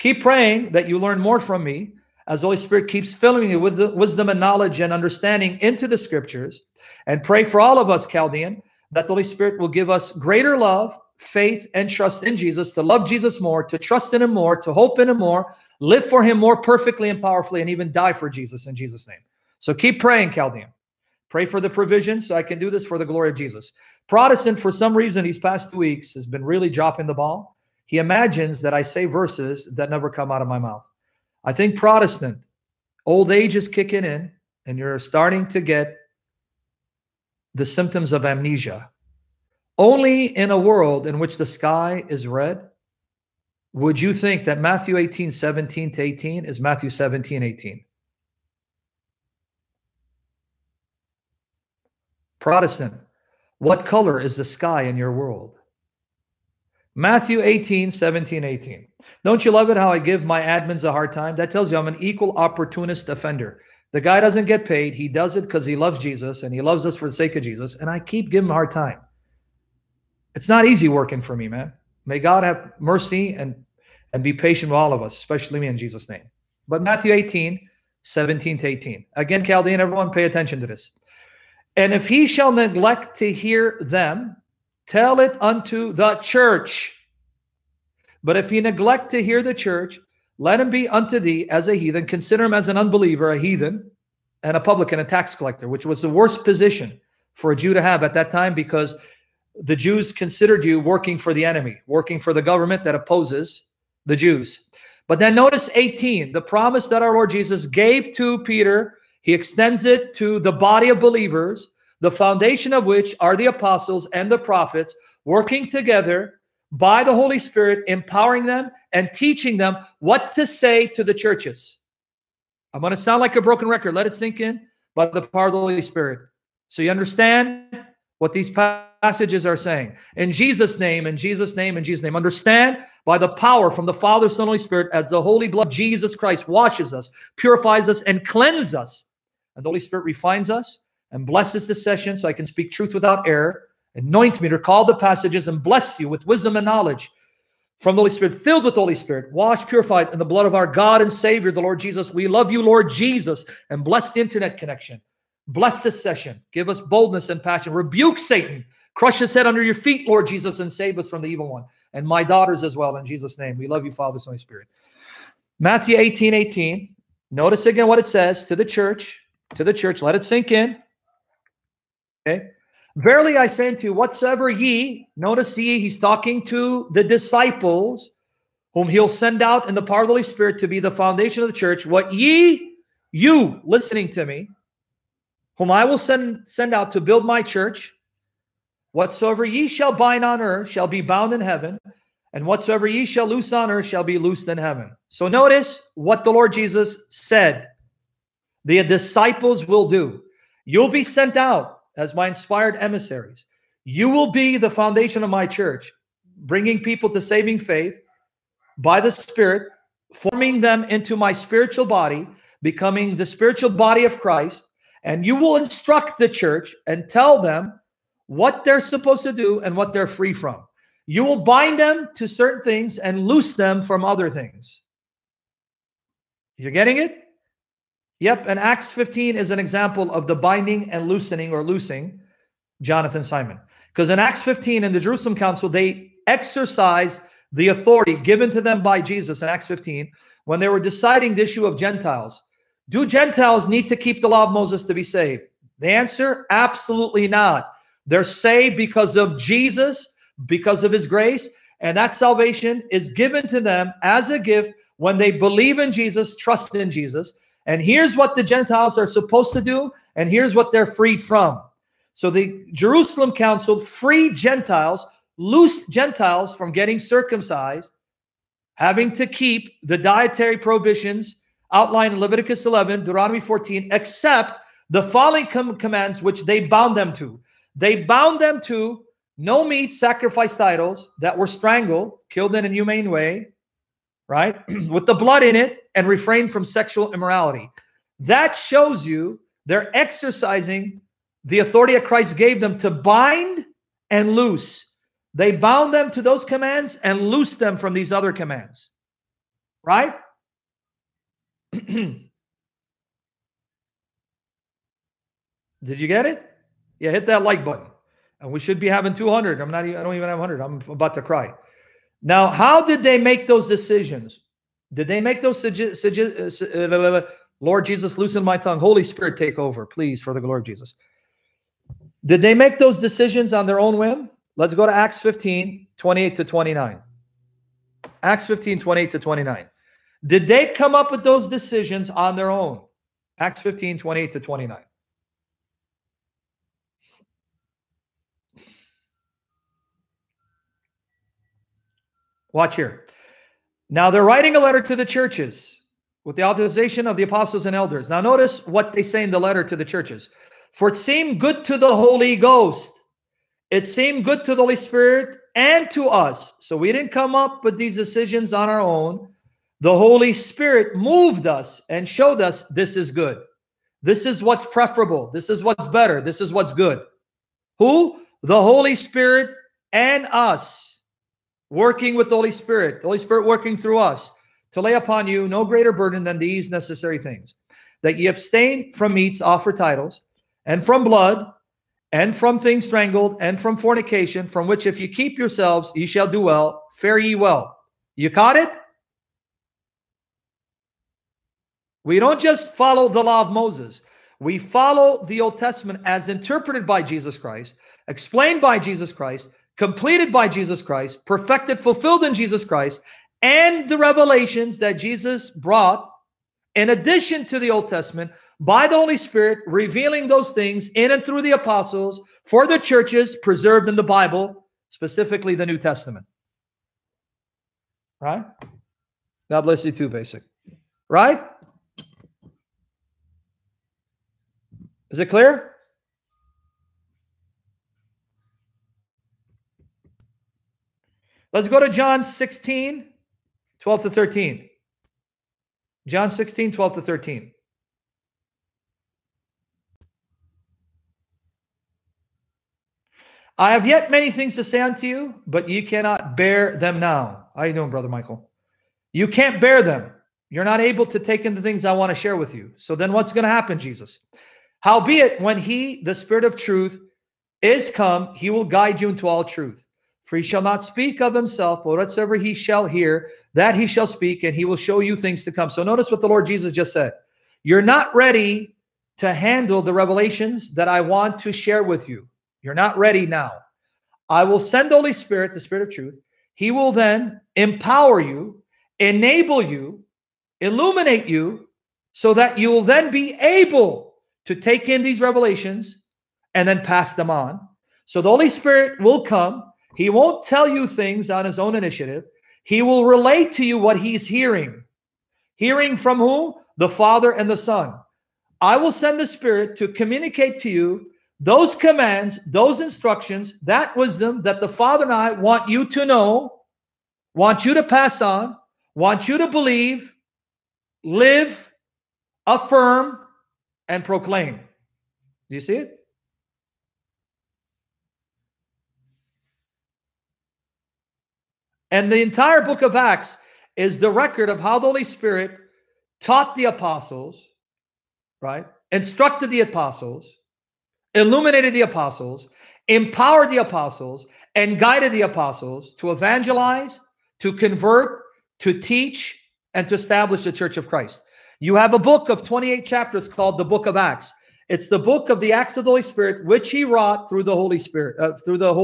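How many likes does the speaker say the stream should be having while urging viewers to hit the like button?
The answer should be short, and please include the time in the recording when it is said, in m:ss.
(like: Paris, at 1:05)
200, at 5:09.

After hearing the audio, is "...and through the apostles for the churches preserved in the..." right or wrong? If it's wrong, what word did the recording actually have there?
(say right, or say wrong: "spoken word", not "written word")
right.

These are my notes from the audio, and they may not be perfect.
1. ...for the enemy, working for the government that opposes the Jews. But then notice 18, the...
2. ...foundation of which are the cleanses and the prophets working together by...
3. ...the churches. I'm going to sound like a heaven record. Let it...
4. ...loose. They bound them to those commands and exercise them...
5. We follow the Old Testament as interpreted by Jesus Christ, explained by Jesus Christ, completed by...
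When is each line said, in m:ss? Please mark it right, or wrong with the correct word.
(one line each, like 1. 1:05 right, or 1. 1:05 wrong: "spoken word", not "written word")
1. 1:41 right
2. 1:52 wrong: "apostles", not "cleanses"
3. 2:01 wrong: "broken", not "heaven"
4. 4:54 wrong: "loose", not "exercise"
5. 6:34 right.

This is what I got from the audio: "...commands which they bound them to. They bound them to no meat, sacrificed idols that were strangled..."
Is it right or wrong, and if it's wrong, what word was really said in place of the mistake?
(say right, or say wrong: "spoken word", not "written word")
right.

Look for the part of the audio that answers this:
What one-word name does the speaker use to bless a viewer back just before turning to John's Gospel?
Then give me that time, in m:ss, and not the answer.
7:00.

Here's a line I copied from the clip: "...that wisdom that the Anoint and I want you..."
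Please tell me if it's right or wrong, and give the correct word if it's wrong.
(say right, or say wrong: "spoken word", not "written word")
wrong: "Father", not "Anoint".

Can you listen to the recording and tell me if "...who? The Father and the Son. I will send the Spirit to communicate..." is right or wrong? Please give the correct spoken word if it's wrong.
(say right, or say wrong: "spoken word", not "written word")
right.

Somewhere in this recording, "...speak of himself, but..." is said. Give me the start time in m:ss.
7:40.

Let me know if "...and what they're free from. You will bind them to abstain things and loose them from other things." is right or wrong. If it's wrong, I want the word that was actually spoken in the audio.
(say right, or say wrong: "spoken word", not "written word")
wrong: "certain", not "abstain".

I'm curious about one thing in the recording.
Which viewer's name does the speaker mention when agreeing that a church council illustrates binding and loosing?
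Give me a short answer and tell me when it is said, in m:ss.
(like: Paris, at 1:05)
Jonathan Simon, at 3:52.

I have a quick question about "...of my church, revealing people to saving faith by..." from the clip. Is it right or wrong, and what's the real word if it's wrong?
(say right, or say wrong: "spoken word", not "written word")
wrong: "bringing", not "revealing".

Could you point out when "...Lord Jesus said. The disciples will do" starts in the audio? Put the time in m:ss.
3:16.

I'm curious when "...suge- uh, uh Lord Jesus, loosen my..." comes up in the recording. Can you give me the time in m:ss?
5:15.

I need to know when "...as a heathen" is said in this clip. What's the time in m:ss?
1:31.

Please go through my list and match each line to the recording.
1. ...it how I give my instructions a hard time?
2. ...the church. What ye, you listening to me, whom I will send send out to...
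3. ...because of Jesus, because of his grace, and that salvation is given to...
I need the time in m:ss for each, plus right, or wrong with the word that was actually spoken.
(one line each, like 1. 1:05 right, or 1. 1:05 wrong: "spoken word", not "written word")
1. 0:59 wrong: "admins", not "instructions"
2. 3:01 right
3. 4:08 right.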